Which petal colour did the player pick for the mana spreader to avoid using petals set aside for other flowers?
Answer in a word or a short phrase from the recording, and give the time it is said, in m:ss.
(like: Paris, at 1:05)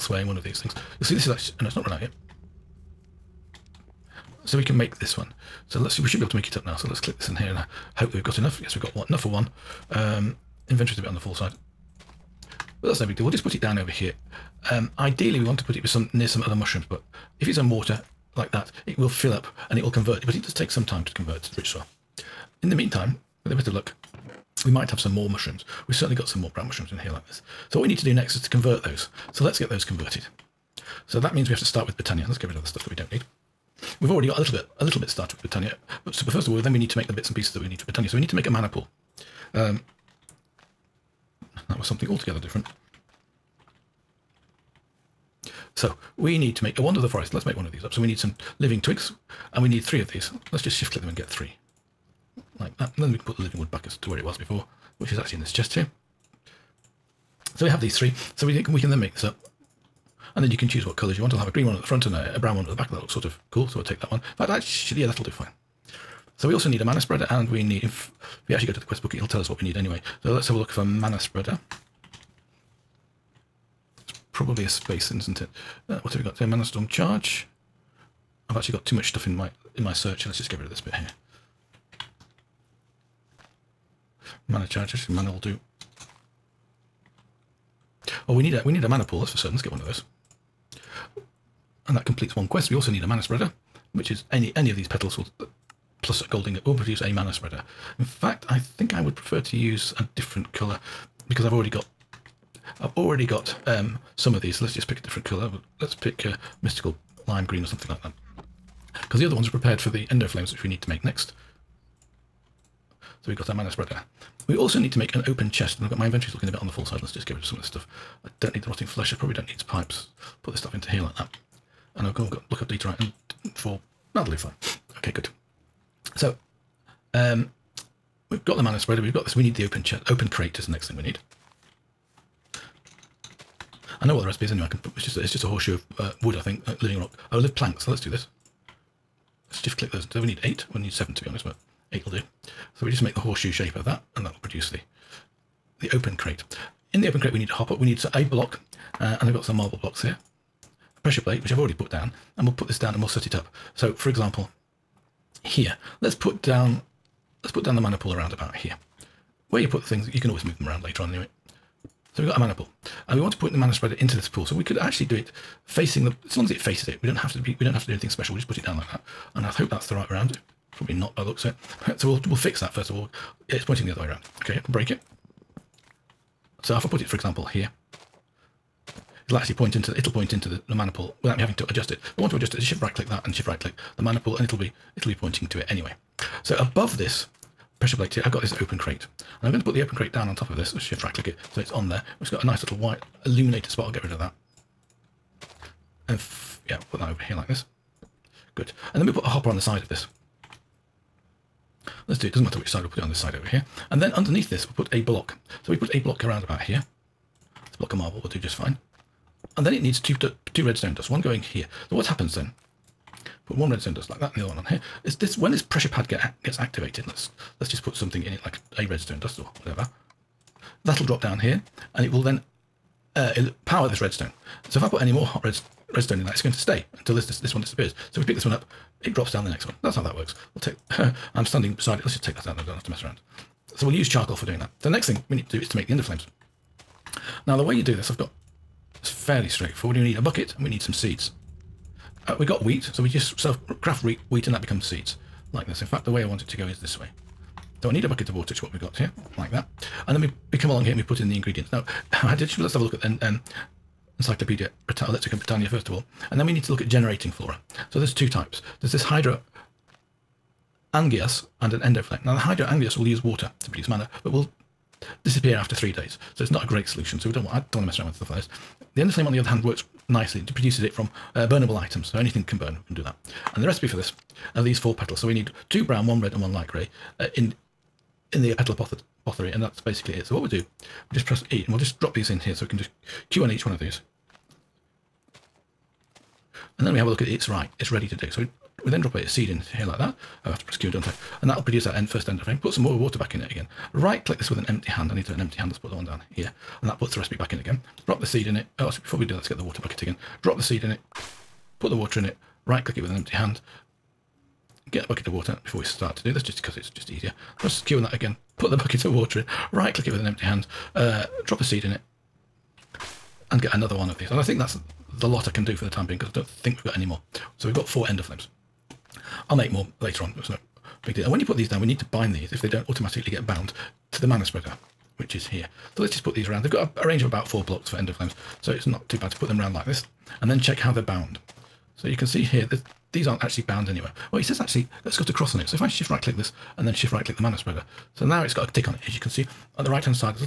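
Mystical lime green, at 1:46.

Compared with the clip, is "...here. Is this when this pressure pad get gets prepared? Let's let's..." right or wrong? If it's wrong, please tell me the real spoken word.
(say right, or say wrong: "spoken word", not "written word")
wrong: "activated", not "prepared".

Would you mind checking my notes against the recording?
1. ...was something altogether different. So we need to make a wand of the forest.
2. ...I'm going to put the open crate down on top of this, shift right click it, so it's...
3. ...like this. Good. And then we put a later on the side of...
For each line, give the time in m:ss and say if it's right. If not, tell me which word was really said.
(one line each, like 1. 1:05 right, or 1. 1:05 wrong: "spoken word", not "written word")
1. 0:41 right
2. 3:09 right
3. 3:17 wrong: "hopper", not "later".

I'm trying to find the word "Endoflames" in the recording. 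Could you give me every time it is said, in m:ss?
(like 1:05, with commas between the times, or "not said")
1:50, 3:55, 4:21, 5:18, 5:27.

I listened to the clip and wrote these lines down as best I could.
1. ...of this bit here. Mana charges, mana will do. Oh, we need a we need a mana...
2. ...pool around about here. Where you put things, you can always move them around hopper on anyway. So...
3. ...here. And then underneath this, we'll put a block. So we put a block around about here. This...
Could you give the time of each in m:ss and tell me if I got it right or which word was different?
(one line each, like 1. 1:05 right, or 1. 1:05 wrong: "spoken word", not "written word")
1. 1:20 right
2. 2:37 wrong: "later", not "hopper"
3. 3:23 right.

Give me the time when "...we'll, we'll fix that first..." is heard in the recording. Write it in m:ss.
2:52.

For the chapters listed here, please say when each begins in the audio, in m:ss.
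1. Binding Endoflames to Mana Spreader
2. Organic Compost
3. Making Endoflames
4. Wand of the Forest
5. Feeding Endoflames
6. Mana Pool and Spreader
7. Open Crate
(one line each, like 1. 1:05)
1. 5:29
2. 0:06
3. 3:54
4. 0:44
5. 2:33
6. 1:25
7. 2:09.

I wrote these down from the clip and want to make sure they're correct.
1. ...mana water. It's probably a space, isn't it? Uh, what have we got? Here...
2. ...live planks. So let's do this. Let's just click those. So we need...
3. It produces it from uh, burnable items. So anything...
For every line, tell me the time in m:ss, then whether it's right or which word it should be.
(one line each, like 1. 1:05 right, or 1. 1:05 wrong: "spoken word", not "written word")
1. 1:10 wrong: "spreader", not "water"
2. 2:17 right
3. 4:30 right.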